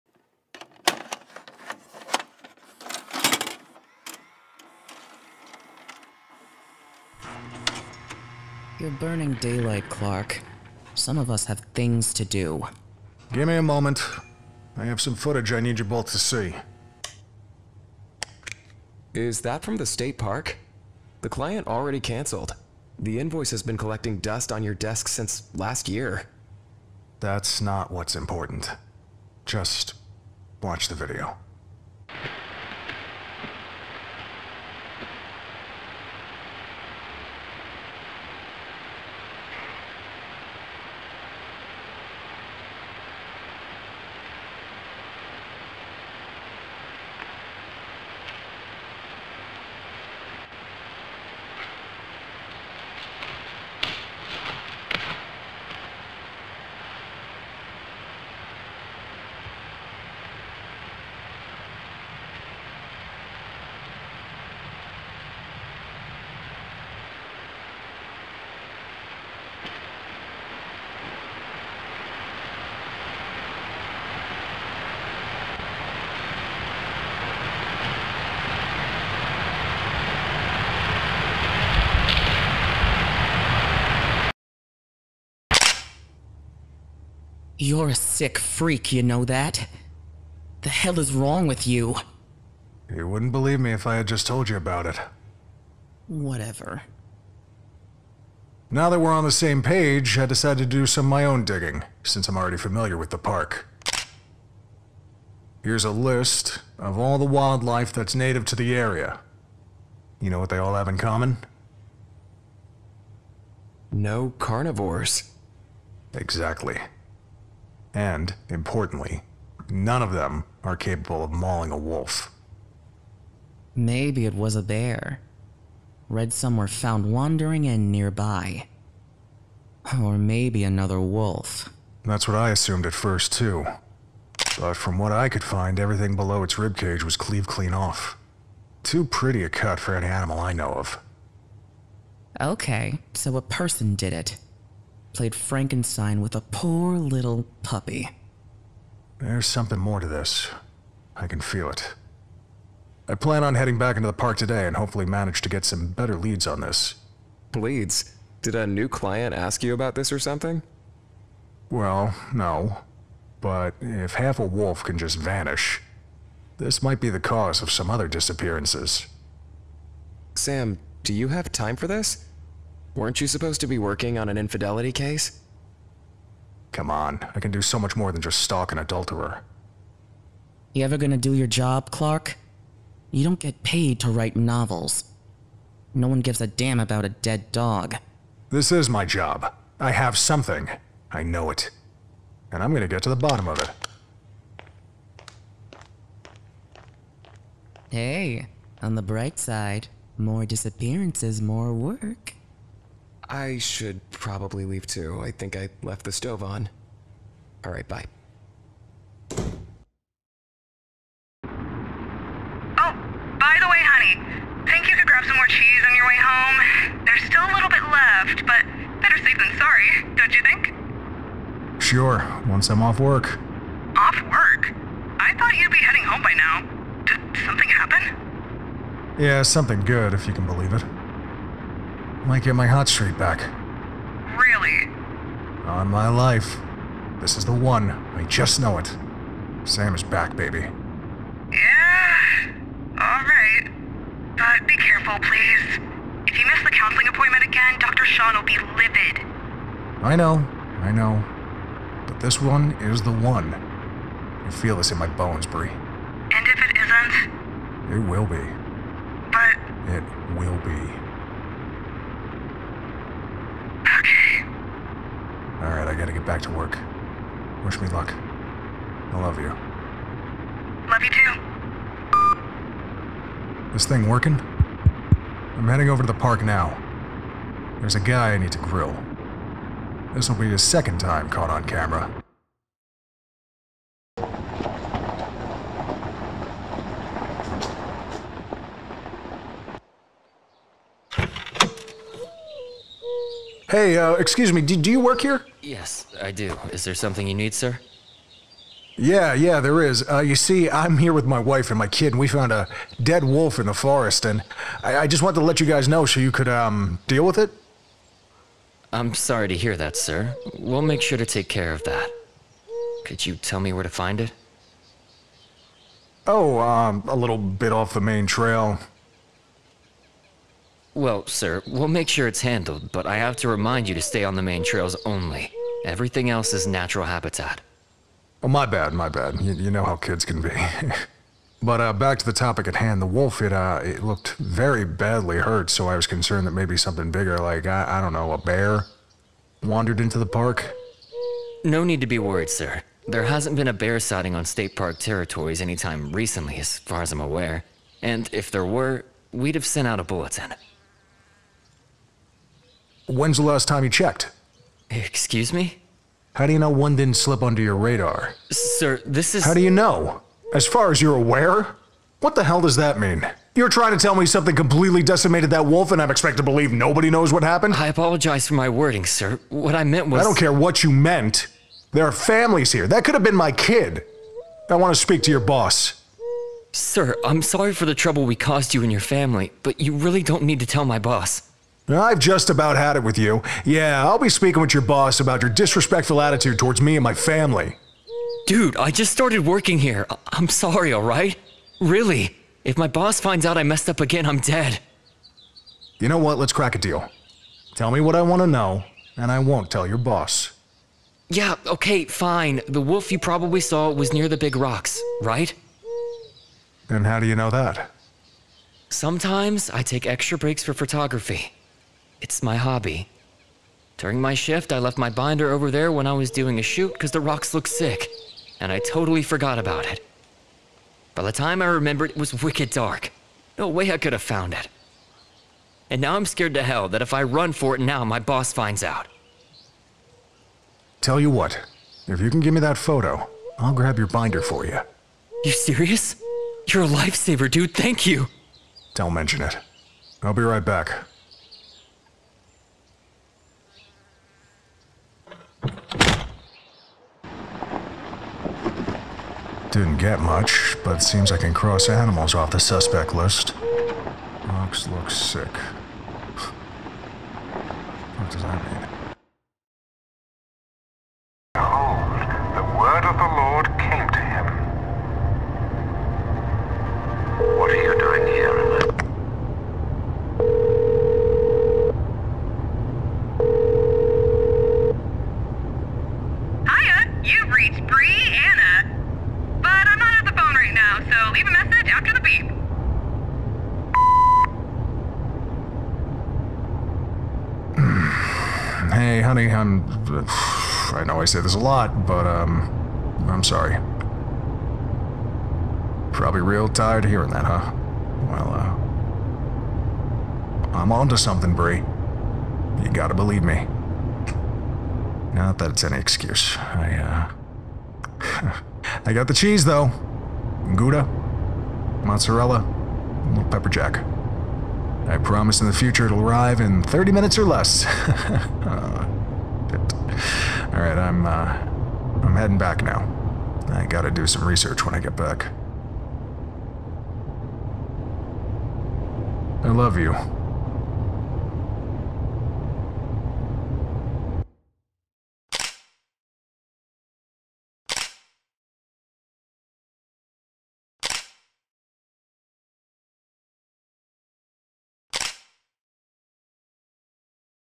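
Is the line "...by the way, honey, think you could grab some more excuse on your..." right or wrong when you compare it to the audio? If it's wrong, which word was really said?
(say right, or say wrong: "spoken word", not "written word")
wrong: "cheese", not "excuse".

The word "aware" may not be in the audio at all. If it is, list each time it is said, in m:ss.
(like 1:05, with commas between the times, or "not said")
5:47, 6:01.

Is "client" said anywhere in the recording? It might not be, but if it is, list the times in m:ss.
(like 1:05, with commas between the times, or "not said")
0:21, 2:38.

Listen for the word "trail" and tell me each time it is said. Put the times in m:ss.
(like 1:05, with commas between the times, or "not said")
5:18, 5:24.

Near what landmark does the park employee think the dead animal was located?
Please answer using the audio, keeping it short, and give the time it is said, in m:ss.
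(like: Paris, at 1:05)
The big rocks, at 6:44.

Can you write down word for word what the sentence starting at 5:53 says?
When's the last time you checked?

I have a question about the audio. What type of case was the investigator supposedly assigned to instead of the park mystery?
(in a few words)
Infidelity case.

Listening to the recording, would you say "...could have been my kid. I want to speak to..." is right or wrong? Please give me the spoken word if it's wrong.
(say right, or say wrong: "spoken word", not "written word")
right.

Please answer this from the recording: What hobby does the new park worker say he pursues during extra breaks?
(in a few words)
Photography.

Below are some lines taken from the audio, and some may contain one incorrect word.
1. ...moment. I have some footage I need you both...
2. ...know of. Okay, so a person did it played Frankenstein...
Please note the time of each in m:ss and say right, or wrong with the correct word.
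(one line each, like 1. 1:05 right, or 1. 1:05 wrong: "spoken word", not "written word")
1. 0:13 right
2. 2:20 right.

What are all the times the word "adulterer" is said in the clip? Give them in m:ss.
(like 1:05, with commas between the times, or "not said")
2:58.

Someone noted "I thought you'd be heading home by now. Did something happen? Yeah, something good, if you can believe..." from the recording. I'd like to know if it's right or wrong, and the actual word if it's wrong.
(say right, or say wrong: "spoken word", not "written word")
right.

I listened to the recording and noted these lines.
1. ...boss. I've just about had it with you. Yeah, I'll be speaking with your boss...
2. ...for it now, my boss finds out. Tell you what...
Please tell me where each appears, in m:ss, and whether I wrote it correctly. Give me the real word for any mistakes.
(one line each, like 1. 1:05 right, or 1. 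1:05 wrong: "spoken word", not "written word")
1. 6:20 right
2. 7:07 right.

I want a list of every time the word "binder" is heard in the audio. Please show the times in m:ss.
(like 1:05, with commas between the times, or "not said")
6:55, 7:14.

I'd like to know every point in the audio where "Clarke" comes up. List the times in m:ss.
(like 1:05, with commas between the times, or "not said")
0:09, 3:01.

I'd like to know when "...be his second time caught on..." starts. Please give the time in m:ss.
4:40.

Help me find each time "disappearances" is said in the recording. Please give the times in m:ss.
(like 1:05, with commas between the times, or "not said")
2:48, 3:20.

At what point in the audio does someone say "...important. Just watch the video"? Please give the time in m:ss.
0:28.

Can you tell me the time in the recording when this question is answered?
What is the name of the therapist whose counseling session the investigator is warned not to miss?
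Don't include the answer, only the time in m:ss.
4:07.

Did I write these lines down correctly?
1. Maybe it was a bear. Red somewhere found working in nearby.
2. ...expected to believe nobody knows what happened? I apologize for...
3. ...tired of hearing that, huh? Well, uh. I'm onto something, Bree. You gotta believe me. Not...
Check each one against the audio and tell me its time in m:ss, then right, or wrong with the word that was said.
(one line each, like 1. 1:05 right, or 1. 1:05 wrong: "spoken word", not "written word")
1. 2:03 wrong: "wandering", not "working"
2. 6:06 right
3. 8:16 right.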